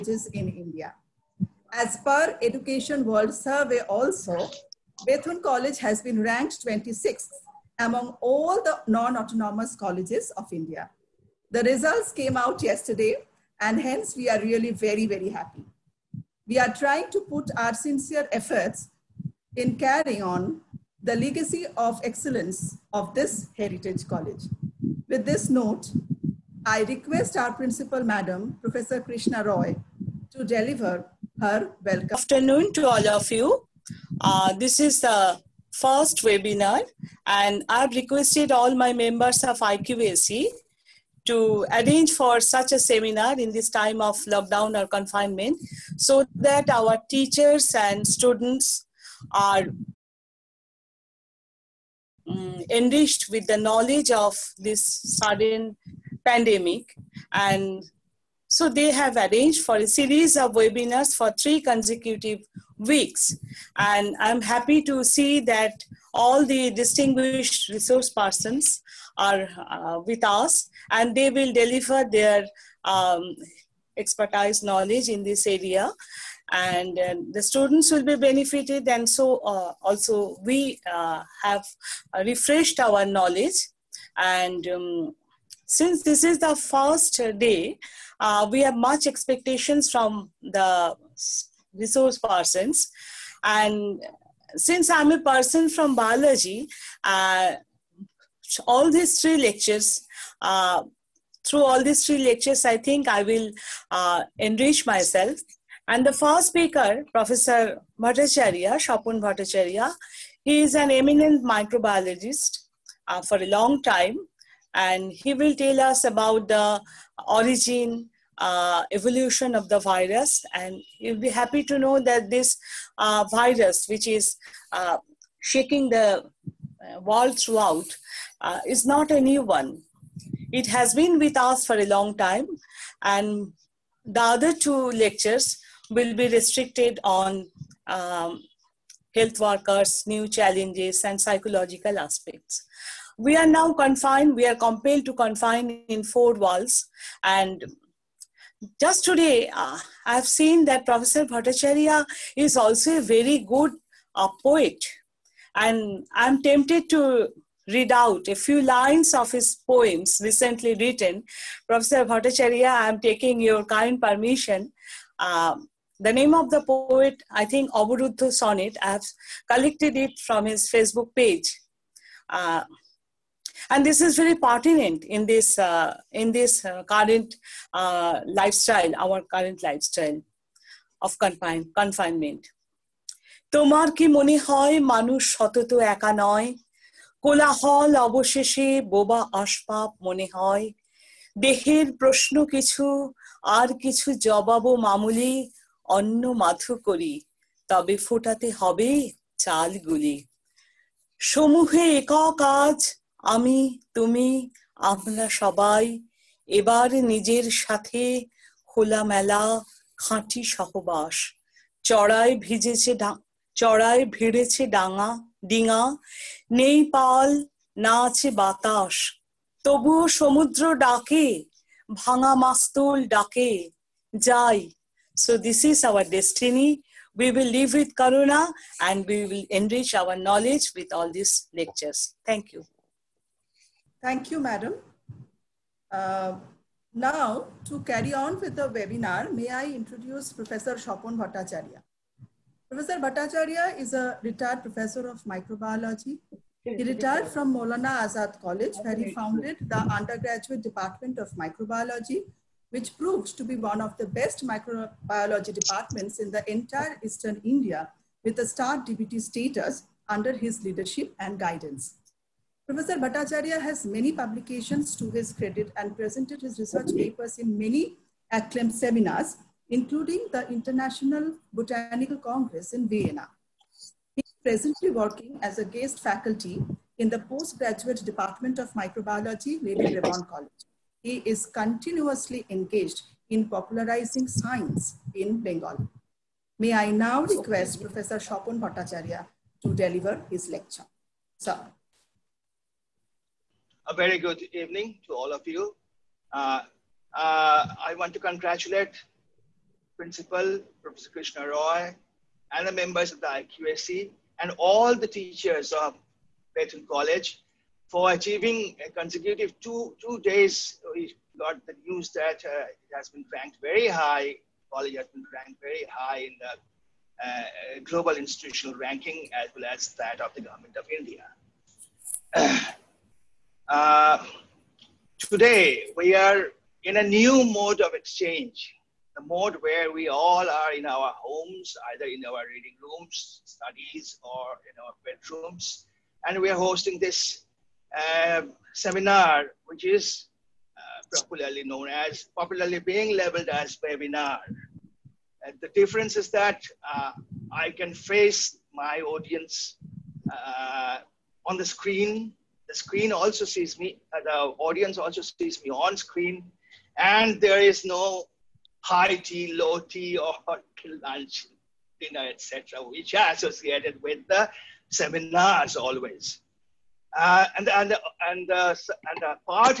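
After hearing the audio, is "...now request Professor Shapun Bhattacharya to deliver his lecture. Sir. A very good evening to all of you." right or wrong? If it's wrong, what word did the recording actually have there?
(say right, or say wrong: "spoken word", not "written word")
right.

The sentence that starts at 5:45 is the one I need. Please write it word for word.
And the difference is that uh, I can face my audience uh, on the screen.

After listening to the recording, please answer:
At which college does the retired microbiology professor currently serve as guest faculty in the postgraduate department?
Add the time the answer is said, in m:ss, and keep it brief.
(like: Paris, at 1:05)
Lady Devon College, at 4:39.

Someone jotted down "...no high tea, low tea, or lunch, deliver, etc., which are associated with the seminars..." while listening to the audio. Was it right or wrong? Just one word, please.
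wrong.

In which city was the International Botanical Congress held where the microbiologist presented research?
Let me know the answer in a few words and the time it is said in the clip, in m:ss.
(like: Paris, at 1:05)
Vienna, at 4:32.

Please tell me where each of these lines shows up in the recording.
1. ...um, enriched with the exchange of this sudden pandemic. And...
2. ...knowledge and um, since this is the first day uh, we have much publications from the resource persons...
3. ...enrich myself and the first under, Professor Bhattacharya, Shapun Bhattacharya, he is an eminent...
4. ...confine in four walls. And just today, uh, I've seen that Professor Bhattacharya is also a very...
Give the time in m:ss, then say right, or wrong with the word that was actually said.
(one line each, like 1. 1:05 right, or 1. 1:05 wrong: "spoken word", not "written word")
1. 0:52 wrong: "knowledge", not "exchange"
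2. 1:23 wrong: "expectations", not "publications"
3. 1:44 wrong: "speaker", not "under"
4. 2:25 right.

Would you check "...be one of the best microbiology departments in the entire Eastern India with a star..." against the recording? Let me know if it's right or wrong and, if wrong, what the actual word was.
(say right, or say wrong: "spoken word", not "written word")
right.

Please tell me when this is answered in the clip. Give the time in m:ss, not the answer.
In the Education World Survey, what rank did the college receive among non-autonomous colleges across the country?
0:06.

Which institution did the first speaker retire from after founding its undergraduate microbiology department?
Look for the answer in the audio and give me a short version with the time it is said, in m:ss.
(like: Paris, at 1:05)
Molana Azad College, at 4:07.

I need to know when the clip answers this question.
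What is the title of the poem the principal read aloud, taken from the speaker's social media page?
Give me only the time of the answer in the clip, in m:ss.
2:47.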